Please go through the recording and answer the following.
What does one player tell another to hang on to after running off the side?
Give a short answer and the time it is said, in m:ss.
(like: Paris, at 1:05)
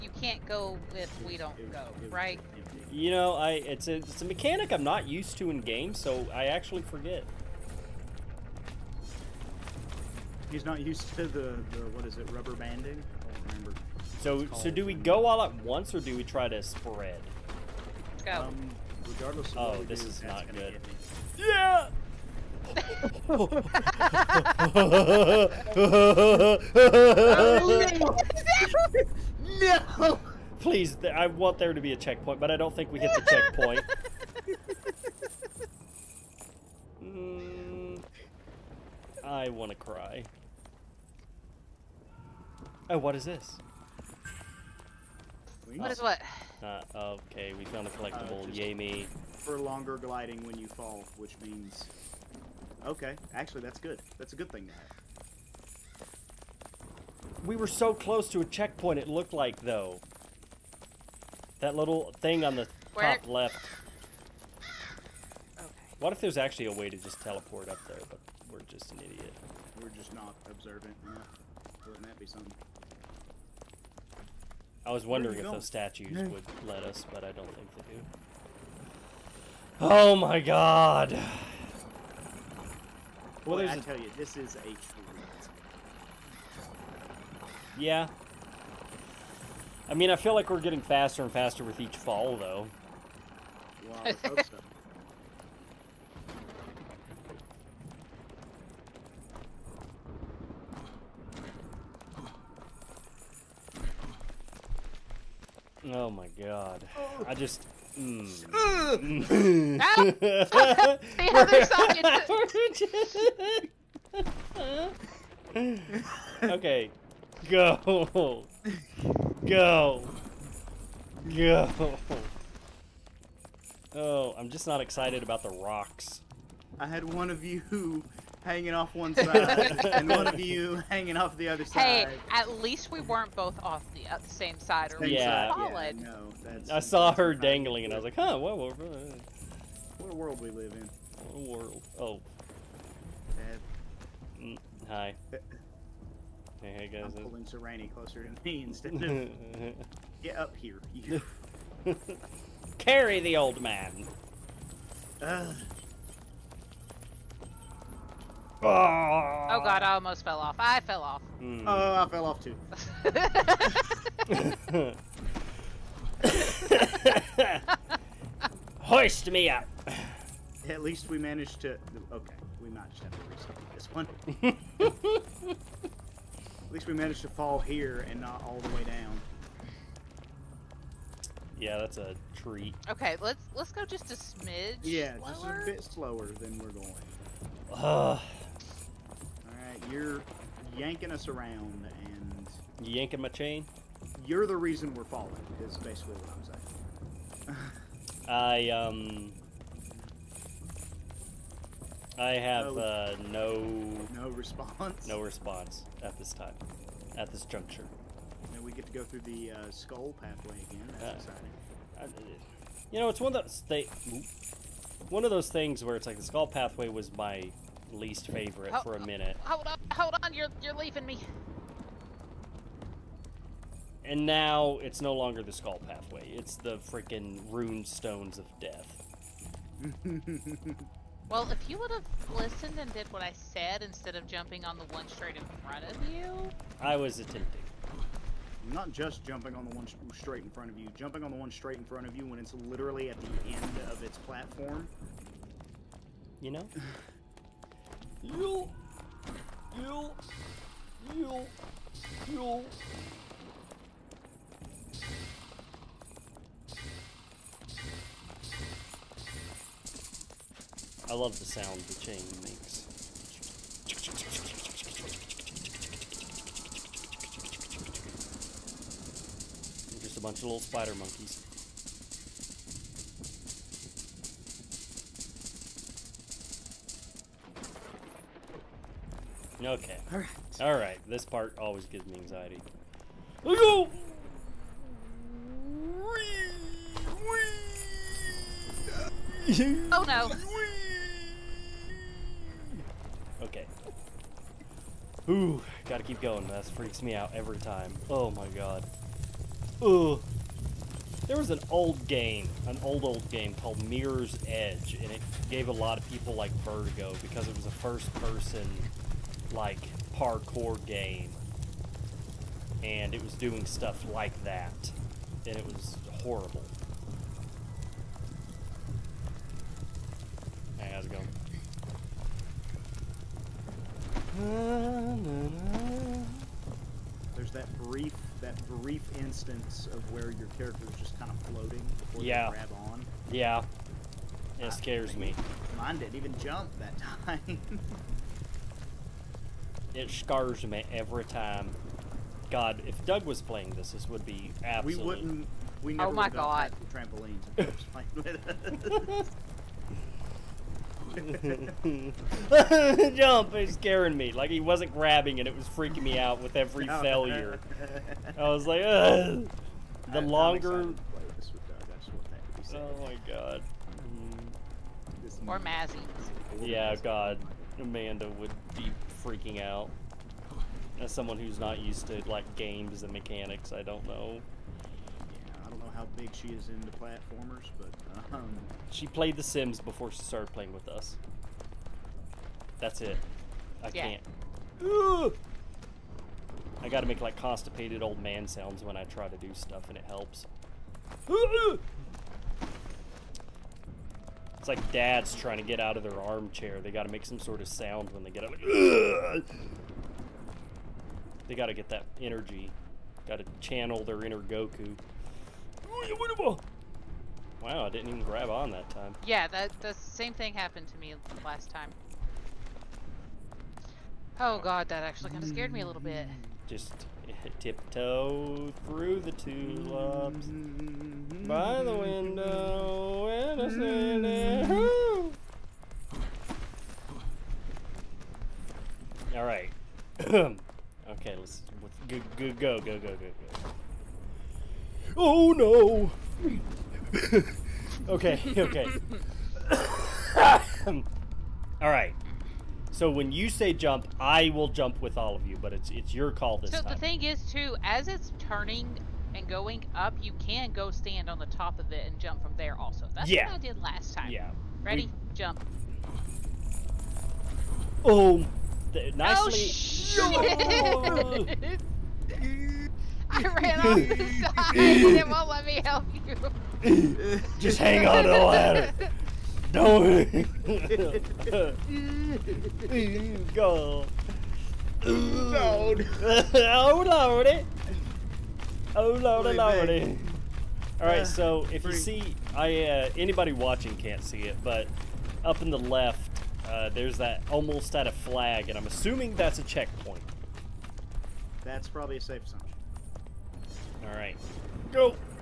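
The ladder, at 7:48.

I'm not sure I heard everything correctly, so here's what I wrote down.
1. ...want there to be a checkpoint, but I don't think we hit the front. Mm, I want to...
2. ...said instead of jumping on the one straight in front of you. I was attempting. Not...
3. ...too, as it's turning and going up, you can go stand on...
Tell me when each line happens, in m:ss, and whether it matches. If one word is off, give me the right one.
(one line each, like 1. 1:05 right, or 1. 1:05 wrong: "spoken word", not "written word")
1. 0:31 wrong: "checkpoint", not "front"
2. 3:53 right
3. 7:27 right.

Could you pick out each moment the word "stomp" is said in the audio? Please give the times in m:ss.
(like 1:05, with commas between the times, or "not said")
not said.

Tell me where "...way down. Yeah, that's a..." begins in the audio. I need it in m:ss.
2:58.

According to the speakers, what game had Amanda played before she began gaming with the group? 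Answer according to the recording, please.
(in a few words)
The Sims.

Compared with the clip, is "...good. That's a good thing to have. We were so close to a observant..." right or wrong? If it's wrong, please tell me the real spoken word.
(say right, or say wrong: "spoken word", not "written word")
wrong: "checkpoint", not "observant".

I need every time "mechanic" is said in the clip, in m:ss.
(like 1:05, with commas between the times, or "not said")
0:04, 6:13.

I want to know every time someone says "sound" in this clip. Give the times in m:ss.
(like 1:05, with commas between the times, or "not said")
4:21, 6:28, 6:37.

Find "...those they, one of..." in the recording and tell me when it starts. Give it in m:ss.
3:33.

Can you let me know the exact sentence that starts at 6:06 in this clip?
Yeah, God, Amanda would be freaking out.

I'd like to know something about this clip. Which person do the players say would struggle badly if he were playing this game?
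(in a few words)
Doug.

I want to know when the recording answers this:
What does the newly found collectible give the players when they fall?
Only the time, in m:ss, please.
0:49.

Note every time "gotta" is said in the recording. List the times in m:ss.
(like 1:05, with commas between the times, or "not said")
4:55, 6:26.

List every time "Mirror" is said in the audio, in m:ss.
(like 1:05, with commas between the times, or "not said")
5:03.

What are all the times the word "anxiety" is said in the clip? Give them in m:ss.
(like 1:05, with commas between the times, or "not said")
4:42.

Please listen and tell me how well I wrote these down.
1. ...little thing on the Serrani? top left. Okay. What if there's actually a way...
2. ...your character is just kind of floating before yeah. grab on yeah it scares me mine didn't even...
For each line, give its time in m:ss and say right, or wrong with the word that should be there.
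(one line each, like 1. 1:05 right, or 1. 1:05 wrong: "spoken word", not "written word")
1. 1:01 wrong: "Where", not "Serrani"
2. 5:30 right.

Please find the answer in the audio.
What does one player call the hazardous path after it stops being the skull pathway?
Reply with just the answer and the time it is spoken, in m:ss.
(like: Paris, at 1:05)
Rune stones of death, at 3:47.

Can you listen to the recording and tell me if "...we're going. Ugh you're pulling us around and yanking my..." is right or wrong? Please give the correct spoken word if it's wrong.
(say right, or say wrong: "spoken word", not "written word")
wrong: "yanking", not "pulling".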